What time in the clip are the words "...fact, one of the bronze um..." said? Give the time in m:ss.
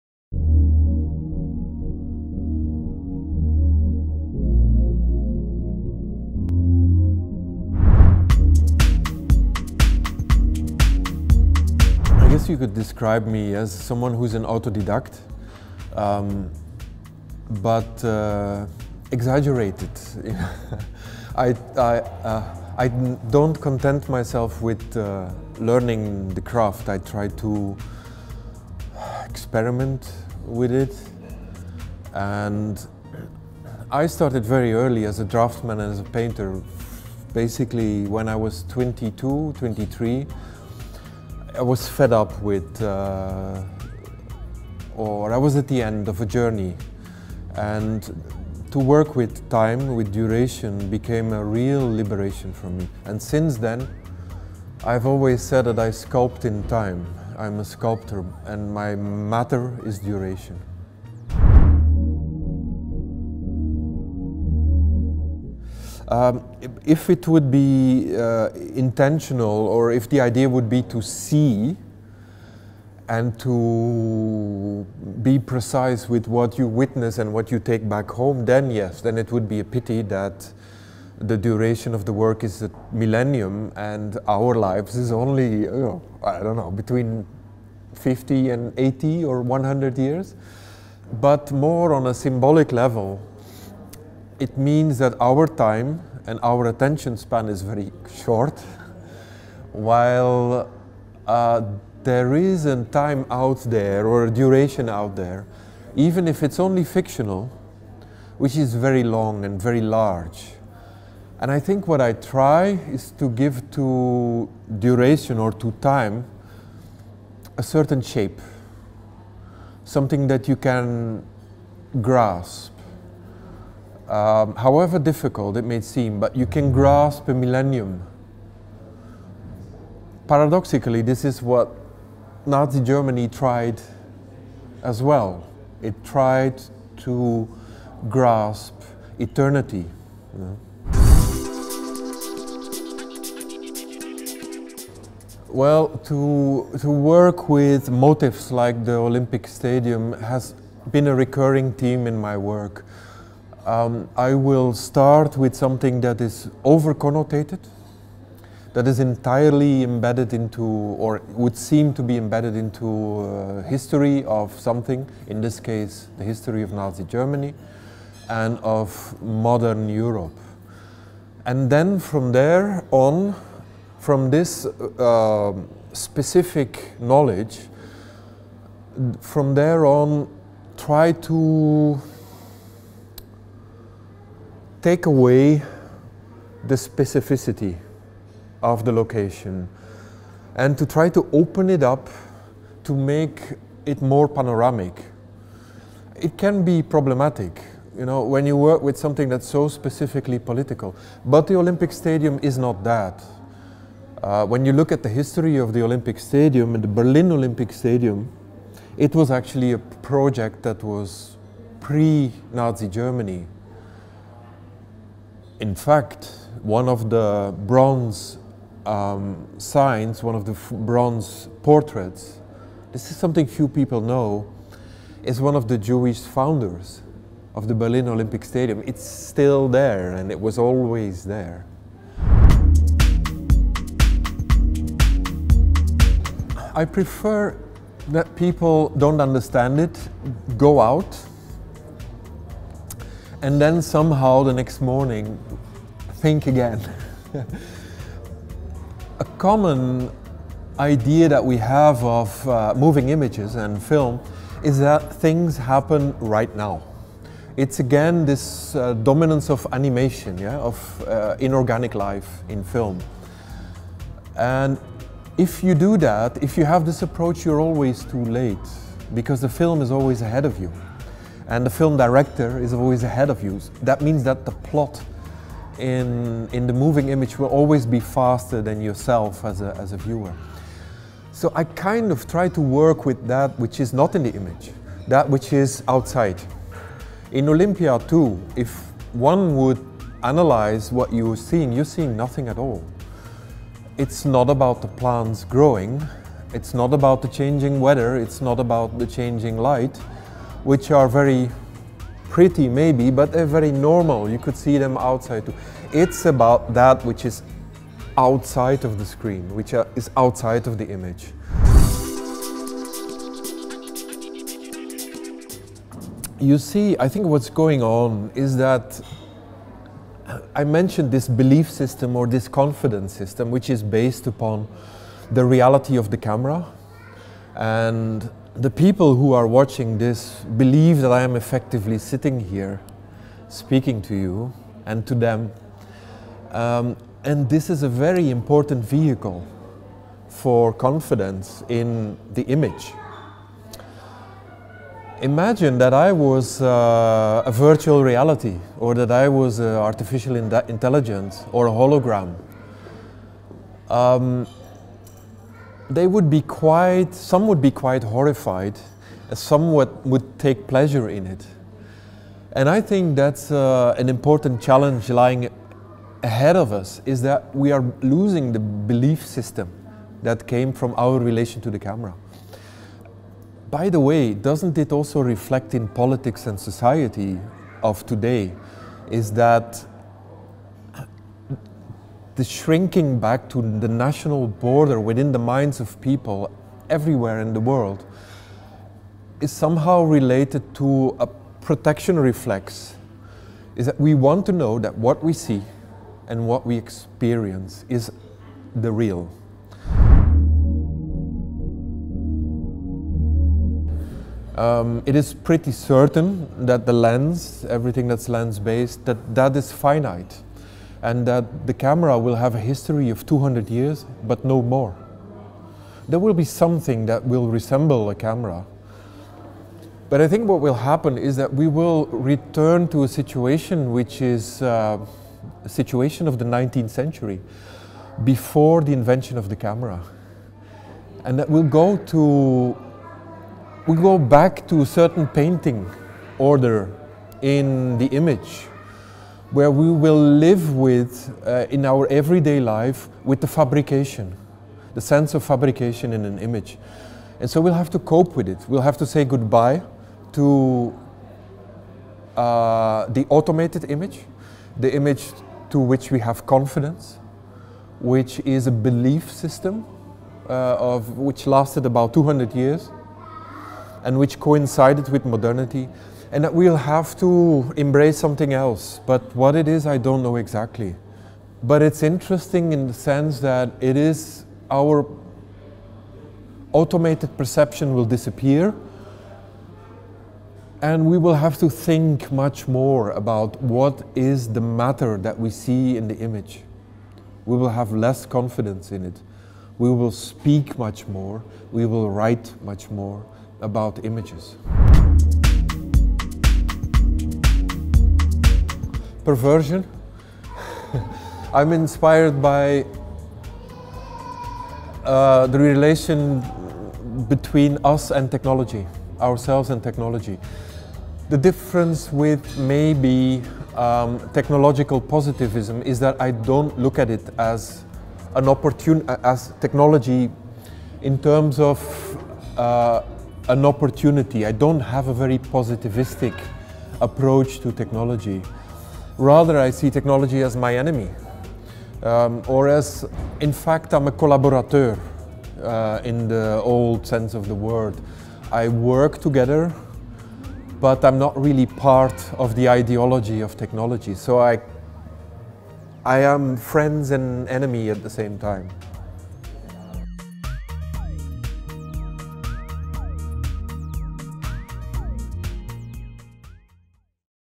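3:35.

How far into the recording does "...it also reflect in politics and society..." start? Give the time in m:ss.
6:14.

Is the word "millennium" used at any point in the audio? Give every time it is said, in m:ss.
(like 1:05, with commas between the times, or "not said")
1:22, 2:07.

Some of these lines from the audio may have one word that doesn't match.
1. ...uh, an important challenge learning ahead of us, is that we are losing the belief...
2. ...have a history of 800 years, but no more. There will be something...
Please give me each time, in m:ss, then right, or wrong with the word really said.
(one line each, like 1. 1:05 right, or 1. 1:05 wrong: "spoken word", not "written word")
1. 6:03 wrong: "lying", not "learning"
2. 6:52 wrong: "200", not "800".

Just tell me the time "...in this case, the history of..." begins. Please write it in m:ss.
2:45.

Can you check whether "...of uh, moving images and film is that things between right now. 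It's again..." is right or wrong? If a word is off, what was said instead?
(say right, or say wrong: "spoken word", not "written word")
wrong: "happen", not "between".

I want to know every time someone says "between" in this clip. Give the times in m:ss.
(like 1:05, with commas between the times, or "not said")
1:26, 8:27.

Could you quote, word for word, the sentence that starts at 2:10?
Paradoxically, this is what Nazi Germany tried as well.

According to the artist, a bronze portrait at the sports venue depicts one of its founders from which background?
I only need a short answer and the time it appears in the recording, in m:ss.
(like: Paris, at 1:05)
Jewish, at 3:45.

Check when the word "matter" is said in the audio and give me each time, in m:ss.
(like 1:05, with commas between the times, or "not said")
0:58, 8:04.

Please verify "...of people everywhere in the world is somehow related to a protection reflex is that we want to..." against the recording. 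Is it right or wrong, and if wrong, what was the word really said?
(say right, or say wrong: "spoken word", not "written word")
right.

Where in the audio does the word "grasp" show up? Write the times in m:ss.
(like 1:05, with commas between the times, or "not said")
2:02, 2:06, 2:18.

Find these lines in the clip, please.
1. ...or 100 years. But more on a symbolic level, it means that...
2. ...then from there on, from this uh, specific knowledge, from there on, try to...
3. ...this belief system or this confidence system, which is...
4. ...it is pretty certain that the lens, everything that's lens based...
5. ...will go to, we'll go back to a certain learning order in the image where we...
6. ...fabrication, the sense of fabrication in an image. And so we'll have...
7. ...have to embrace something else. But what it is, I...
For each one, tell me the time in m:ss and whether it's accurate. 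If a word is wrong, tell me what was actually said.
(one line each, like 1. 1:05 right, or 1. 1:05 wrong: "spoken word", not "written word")
1. 1:29 right
2. 2:51 right
3. 5:21 right
4. 6:45 right
5. 7:11 wrong: "painting", not "learning"
6. 7:23 right
7. 7:46 right.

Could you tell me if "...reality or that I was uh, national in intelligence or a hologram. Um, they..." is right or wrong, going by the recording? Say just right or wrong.
wrong.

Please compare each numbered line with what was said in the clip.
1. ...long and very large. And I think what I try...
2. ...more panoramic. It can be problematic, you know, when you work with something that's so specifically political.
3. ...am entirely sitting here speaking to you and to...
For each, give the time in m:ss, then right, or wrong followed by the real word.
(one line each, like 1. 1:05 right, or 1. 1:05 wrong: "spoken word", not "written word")
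1. 1:49 right
2. 3:14 right
3. 5:31 wrong: "effectively", not "entirely".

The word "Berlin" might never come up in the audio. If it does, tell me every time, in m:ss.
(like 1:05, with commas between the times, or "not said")
3:26, 3:47.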